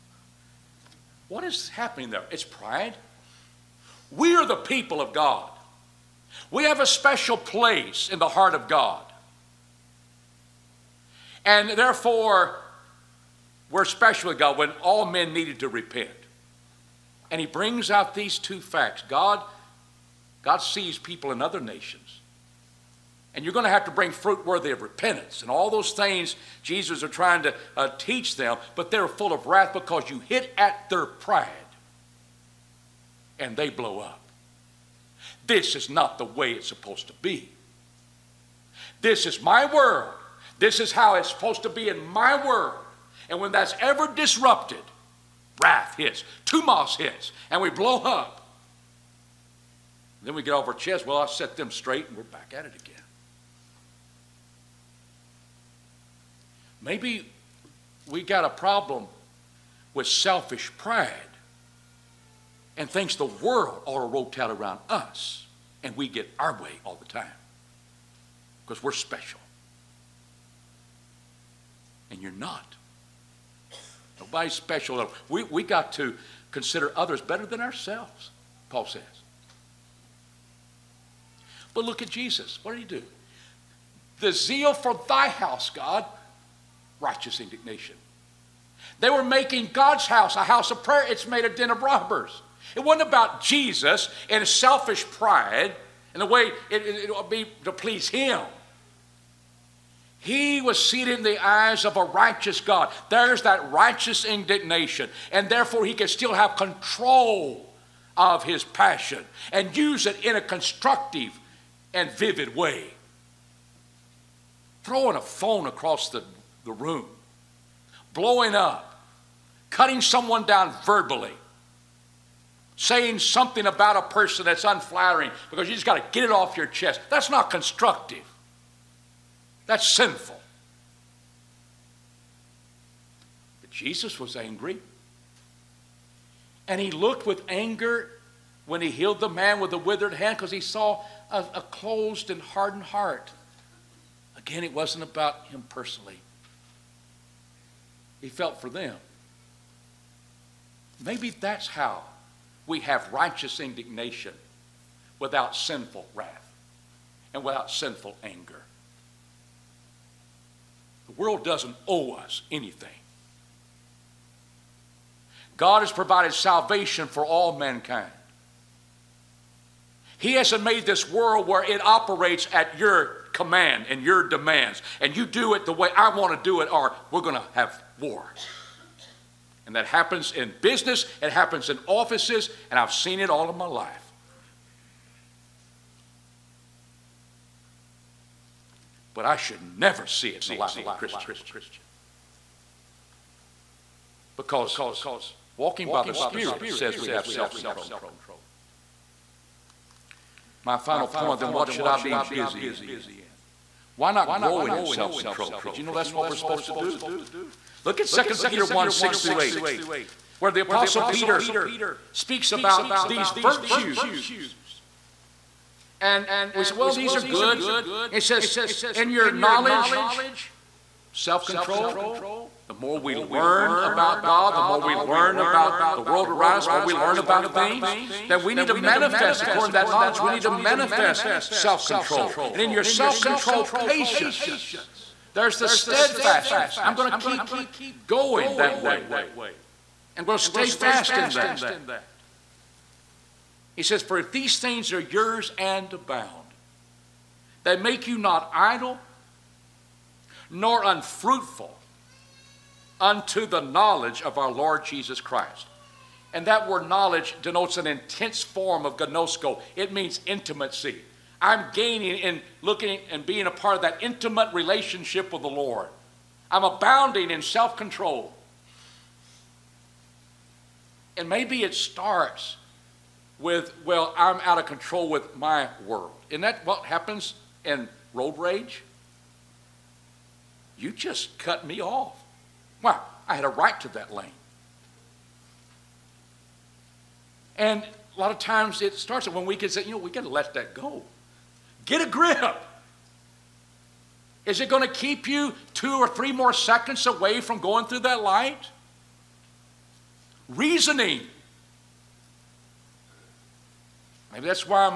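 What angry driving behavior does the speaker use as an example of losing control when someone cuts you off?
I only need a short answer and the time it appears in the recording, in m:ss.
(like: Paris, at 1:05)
road rage, at 4:38.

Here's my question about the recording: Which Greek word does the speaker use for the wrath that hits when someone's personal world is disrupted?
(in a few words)
thumos.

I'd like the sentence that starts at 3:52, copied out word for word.
And in your self control, patience.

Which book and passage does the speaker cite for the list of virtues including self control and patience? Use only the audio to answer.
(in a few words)
2 Peter 1:6-8.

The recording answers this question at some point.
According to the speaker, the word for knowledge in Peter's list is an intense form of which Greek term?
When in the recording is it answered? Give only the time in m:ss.
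4:18.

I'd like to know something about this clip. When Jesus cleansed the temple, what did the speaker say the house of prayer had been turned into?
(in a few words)
den of robbers.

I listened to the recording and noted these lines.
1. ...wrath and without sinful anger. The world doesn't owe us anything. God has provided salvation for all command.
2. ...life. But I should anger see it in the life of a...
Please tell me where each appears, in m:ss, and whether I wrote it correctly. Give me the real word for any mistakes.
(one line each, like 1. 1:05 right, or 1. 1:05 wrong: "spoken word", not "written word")
1. 2:36 wrong: "mankind", not "command"
2. 3:03 wrong: "never", not "anger".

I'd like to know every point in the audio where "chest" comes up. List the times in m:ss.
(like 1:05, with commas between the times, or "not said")
0:50, 2:06.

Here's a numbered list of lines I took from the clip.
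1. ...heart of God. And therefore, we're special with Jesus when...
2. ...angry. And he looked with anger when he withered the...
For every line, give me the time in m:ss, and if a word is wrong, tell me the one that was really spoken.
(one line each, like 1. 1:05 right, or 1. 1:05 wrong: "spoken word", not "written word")
1. 0:08 wrong: "God", not "Jesus"
2. 2:14 wrong: "healed", not "withered".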